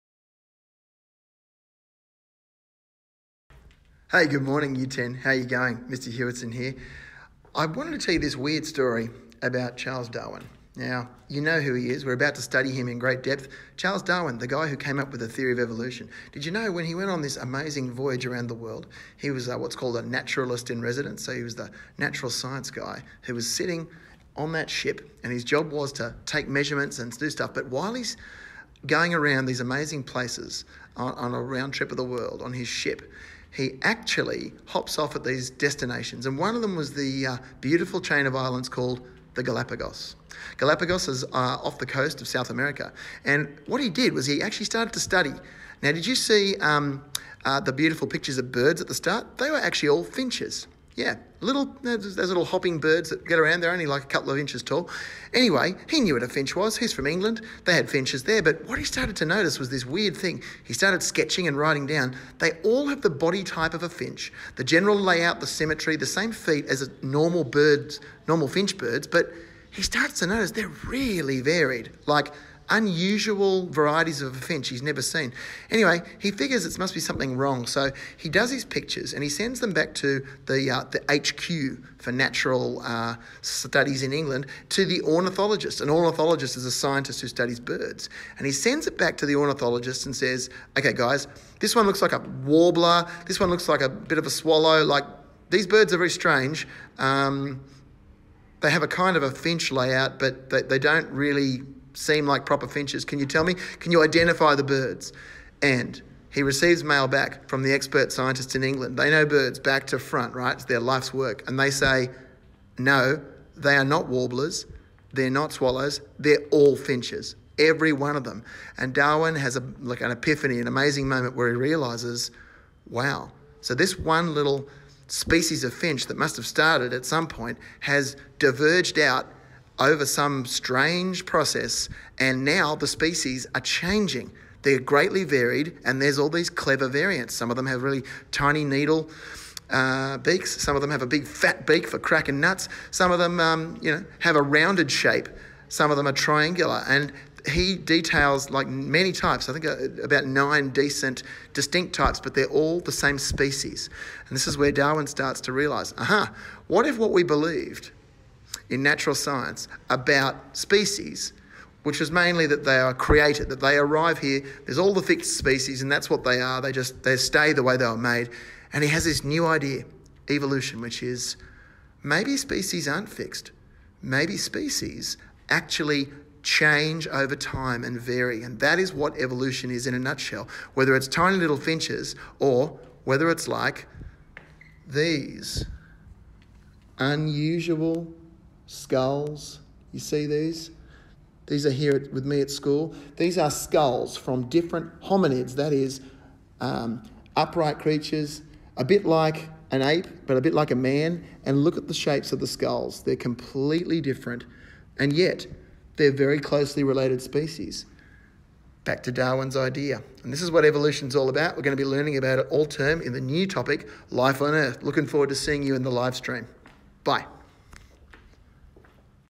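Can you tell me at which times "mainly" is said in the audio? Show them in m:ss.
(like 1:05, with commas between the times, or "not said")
2:42.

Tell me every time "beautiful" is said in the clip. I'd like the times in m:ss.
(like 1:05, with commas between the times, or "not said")
0:37, 0:47.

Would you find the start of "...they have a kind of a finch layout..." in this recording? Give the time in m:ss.
1:38.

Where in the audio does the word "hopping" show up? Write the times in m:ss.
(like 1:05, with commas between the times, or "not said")
0:52.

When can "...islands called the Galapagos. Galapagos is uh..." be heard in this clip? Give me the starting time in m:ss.
0:38.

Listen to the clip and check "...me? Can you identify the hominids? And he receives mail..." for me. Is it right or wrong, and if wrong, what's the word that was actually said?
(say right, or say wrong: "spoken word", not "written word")
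wrong: "birds", not "hominids".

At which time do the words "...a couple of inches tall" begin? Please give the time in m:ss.
0:54.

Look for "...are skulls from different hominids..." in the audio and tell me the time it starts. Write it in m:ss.
3:13.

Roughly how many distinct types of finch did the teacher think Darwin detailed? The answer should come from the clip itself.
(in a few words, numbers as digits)
About 9.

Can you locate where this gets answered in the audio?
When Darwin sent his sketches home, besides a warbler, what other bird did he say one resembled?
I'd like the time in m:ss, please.
1:33.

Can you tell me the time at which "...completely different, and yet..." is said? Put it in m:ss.
3:23.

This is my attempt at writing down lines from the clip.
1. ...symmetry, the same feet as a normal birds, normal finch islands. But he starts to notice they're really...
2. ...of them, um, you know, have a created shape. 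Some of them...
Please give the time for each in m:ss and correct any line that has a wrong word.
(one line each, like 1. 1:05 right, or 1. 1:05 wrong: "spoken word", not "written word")
1. 1:05 wrong: "birds", not "islands"
2. 2:23 wrong: "rounded", not "created".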